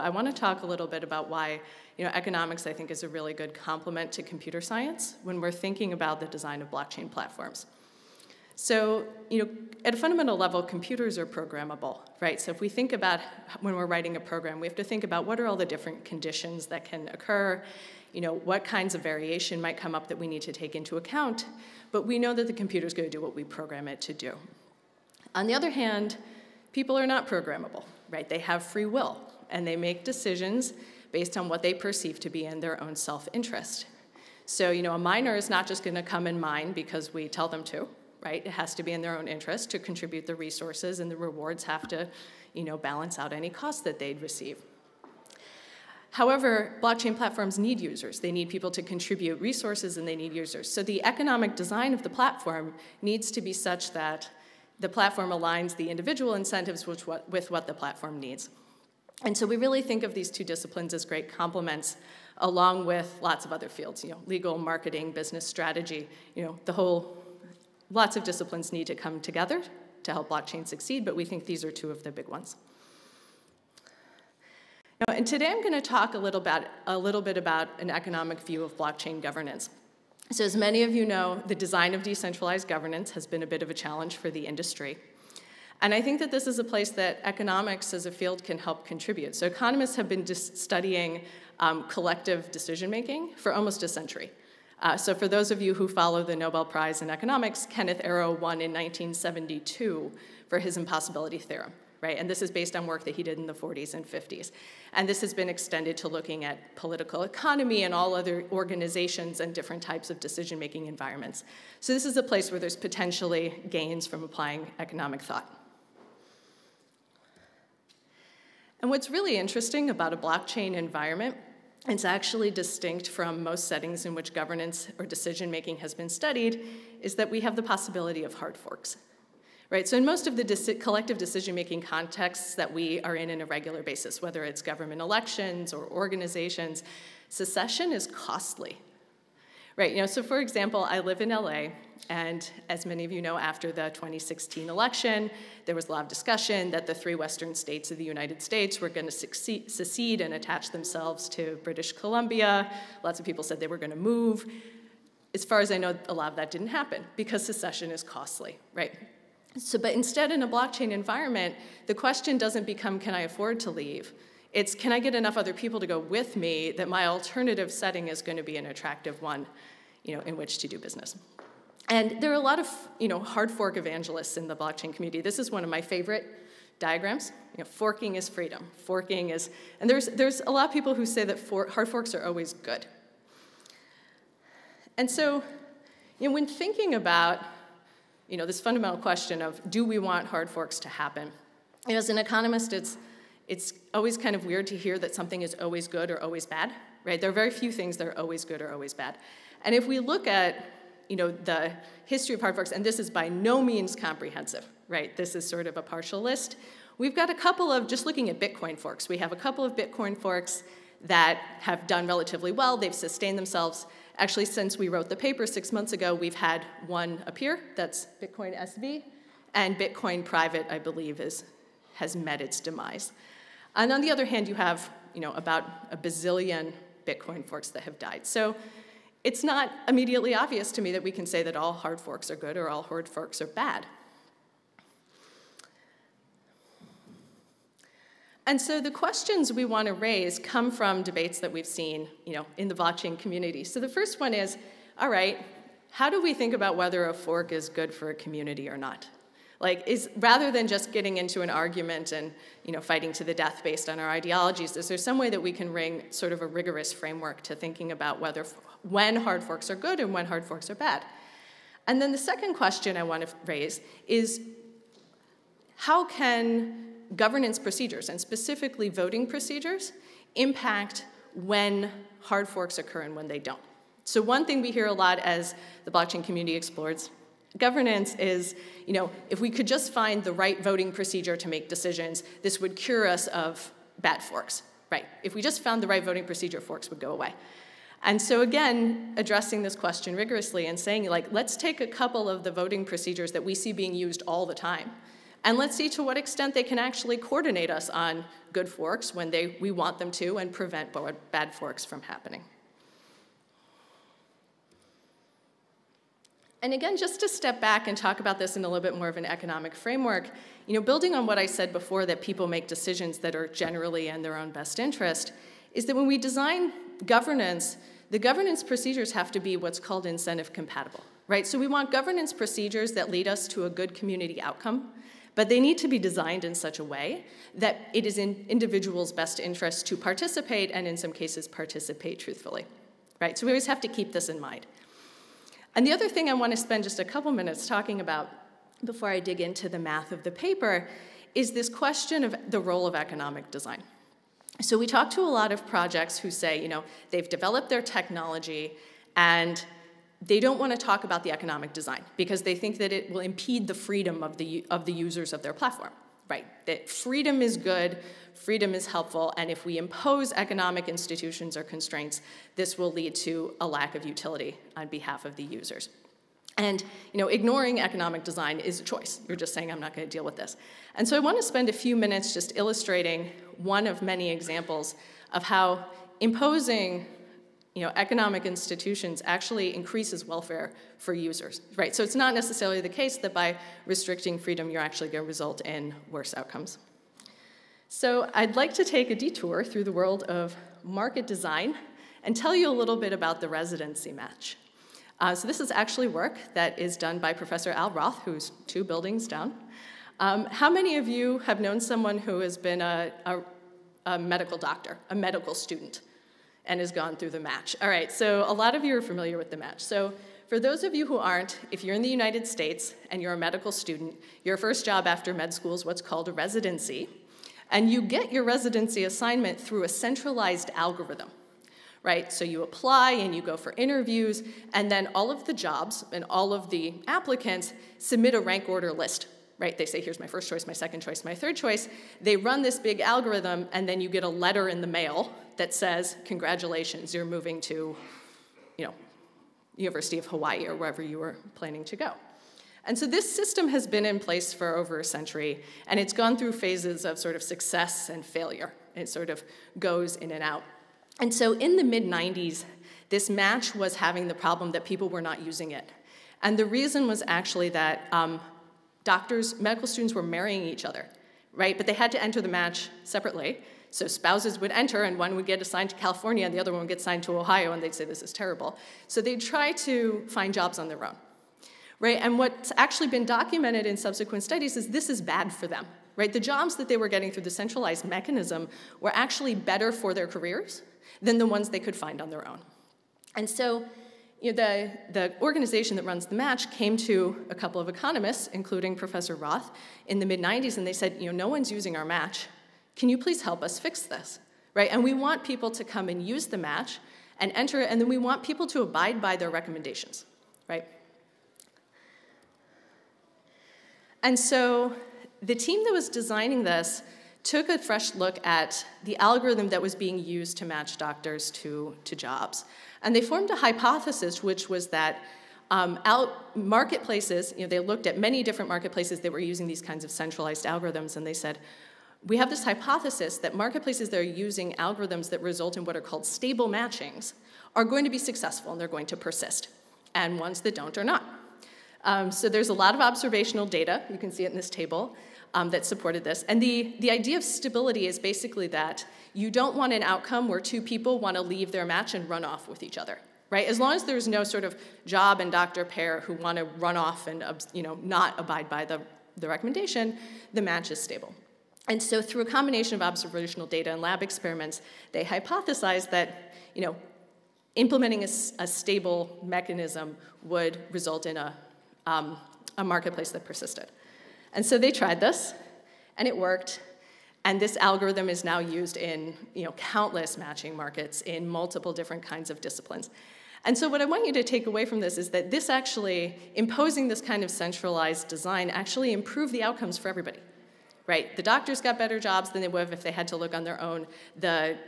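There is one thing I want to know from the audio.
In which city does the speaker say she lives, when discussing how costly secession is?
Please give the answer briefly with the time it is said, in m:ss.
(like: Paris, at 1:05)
LA, at 2:21.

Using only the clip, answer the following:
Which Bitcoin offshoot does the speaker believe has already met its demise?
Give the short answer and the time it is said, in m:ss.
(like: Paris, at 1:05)
Bitcoin Private, at 3:39.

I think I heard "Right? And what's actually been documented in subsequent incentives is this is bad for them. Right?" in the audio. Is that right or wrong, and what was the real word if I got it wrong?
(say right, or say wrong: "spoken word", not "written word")
wrong: "studies", not "incentives".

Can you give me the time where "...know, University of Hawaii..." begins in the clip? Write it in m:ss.
7:18.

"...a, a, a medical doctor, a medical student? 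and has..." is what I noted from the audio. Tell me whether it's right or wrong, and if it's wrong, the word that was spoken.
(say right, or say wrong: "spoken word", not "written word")
right.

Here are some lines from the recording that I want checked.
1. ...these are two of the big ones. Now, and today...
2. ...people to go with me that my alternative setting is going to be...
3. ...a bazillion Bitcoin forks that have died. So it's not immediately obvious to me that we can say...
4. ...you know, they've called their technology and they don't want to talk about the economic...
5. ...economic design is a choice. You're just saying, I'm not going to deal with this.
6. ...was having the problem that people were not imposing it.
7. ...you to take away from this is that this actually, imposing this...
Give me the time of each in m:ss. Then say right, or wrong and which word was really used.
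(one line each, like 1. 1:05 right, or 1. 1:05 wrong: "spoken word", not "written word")
1. 1:11 right
2. 2:45 right
3. 3:45 right
4. 5:46 wrong: "developed", not "called"
5. 6:07 right
6. 7:33 wrong: "using", not "imposing"
7. 9:34 right.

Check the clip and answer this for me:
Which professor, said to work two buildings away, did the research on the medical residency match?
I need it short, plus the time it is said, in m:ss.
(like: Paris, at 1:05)
Al Roth, at 6:37.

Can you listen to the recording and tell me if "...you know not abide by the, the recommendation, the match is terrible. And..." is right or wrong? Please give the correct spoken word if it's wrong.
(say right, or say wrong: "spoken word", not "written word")
wrong: "stable", not "terrible".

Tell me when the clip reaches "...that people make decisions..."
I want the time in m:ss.
5:12.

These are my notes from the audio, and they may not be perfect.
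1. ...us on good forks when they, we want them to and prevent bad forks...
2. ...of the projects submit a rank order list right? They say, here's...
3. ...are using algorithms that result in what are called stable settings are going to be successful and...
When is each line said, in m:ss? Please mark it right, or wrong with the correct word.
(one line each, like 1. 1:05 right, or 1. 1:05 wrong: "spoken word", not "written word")
1. 4:57 right
2. 7:06 wrong: "applicants", not "projects"
3. 8:44 wrong: "matchings", not "settings".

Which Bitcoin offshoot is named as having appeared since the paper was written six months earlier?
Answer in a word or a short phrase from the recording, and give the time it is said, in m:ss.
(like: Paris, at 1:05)
Bitcoin SV, at 3:38.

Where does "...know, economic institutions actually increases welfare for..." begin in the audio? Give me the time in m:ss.
6:17.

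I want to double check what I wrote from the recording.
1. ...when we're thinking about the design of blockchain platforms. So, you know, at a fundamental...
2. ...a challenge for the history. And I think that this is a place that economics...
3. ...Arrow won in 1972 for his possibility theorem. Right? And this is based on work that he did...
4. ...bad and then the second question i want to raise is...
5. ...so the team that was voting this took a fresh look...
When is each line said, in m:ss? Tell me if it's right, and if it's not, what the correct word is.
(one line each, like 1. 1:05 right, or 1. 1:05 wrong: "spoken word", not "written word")
1. 0:05 right
2. 1:23 wrong: "industry", not "history"
3. 1:38 wrong: "impossibility", not "possibility"
4. 4:20 right
5. 8:24 wrong: "designing", not "voting".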